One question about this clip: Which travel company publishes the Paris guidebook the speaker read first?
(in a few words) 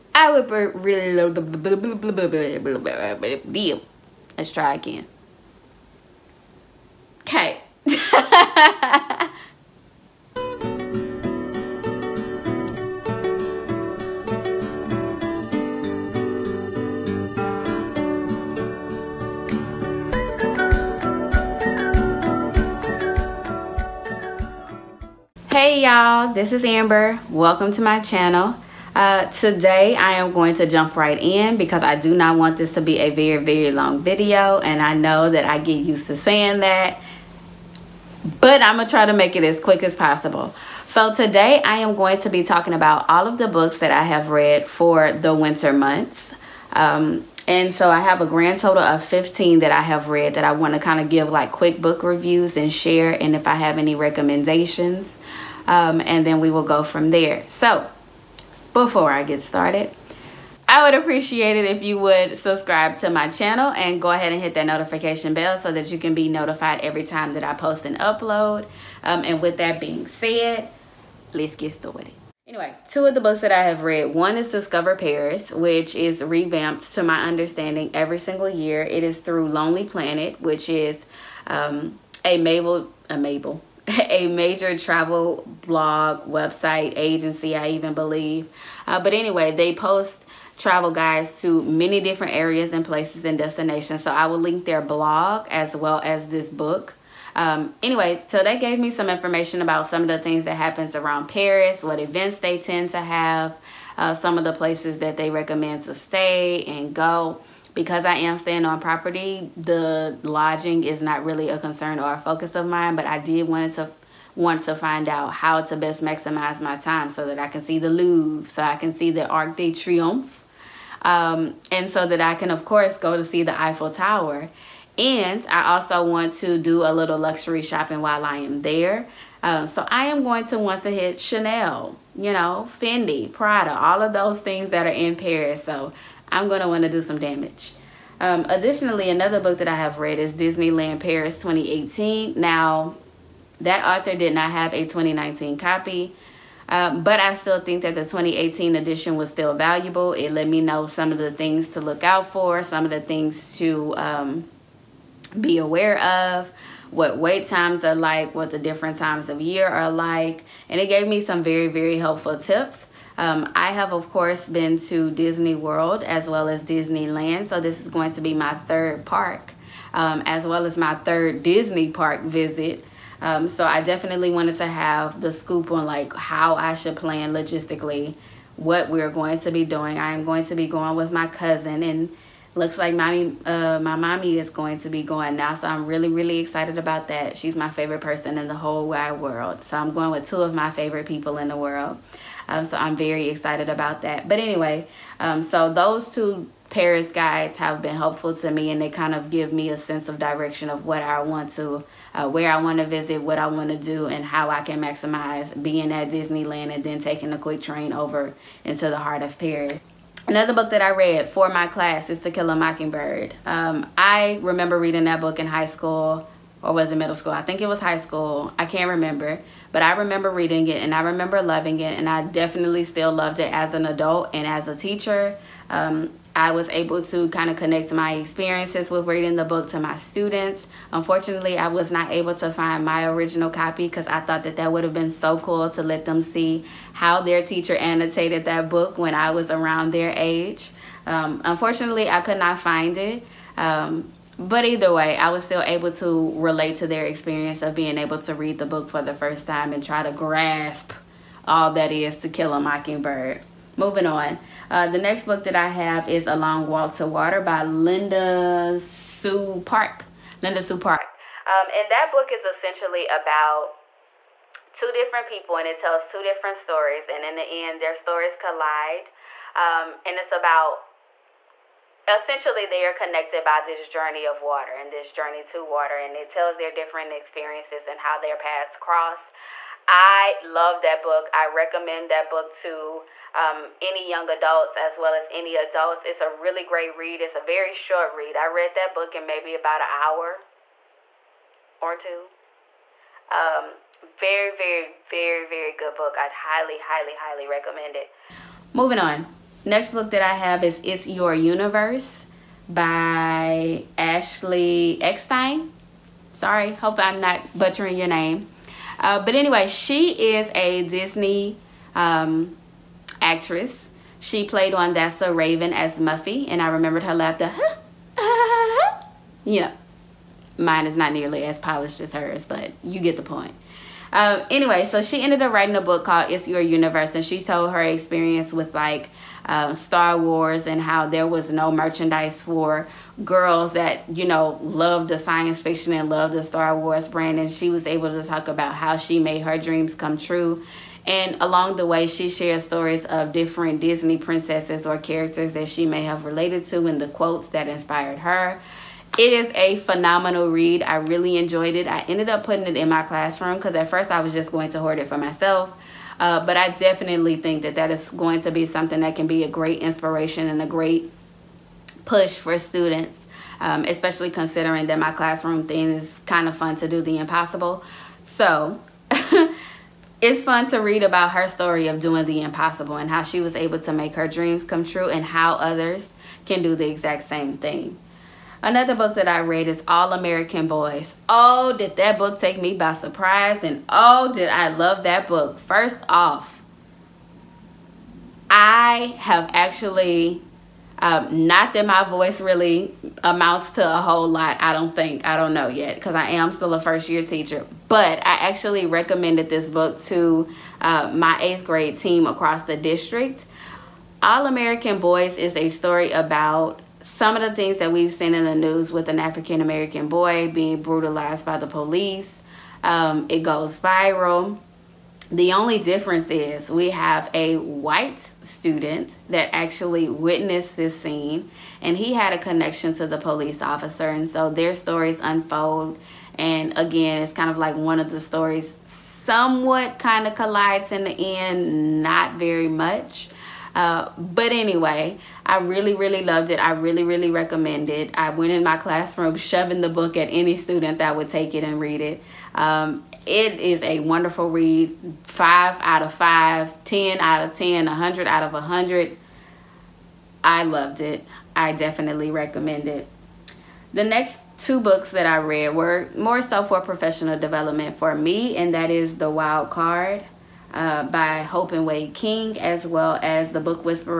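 Lonely Planet.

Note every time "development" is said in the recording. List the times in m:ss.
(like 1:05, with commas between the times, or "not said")
7:37.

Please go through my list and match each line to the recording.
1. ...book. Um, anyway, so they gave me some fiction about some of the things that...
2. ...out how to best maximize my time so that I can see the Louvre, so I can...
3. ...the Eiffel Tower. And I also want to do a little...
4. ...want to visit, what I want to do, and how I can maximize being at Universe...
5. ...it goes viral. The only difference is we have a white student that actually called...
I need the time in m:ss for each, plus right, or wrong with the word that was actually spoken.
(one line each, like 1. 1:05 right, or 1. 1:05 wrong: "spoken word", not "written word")
1. 1:36 wrong: "information", not "fiction"
2. 1:55 right
3. 2:03 right
4. 3:22 wrong: "Disneyland", not "Universe"
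5. 6:53 wrong: "witnessed", not "called".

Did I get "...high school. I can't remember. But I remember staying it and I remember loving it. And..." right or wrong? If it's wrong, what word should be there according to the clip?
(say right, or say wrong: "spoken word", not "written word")
wrong: "reading", not "staying".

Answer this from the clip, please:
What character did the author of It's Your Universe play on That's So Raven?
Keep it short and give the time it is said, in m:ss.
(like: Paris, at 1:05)
Muffy, at 5:15.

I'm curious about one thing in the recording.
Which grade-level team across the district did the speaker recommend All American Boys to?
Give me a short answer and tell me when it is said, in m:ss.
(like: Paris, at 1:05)
Eighth grade, at 6:41.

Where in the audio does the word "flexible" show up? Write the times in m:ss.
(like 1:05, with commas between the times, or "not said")
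not said.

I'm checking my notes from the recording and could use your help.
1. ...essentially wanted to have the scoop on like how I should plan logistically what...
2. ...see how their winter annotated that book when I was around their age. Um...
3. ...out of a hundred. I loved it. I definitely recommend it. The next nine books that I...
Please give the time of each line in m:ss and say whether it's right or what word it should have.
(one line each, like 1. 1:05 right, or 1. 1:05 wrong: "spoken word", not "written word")
1. 2:53 wrong: "definitely", not "essentially"
2. 3:56 wrong: "teacher", not "winter"
3. 7:28 wrong: "two", not "nine".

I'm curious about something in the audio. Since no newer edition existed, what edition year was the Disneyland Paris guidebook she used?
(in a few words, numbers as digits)
2018.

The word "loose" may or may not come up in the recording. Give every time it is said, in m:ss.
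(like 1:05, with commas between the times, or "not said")
not said.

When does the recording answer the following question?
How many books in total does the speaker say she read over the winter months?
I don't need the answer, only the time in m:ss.
0:49.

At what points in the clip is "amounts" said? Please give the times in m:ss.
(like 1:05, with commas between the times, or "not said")
6:33.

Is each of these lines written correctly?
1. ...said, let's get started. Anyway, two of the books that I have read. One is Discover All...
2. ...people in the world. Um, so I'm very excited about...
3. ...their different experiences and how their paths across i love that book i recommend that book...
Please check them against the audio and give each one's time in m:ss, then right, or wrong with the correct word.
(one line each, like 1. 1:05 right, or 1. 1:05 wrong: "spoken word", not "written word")
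1. 1:10 wrong: "Paris", not "All"
2. 3:11 right
3. 4:36 wrong: "cross", not "across".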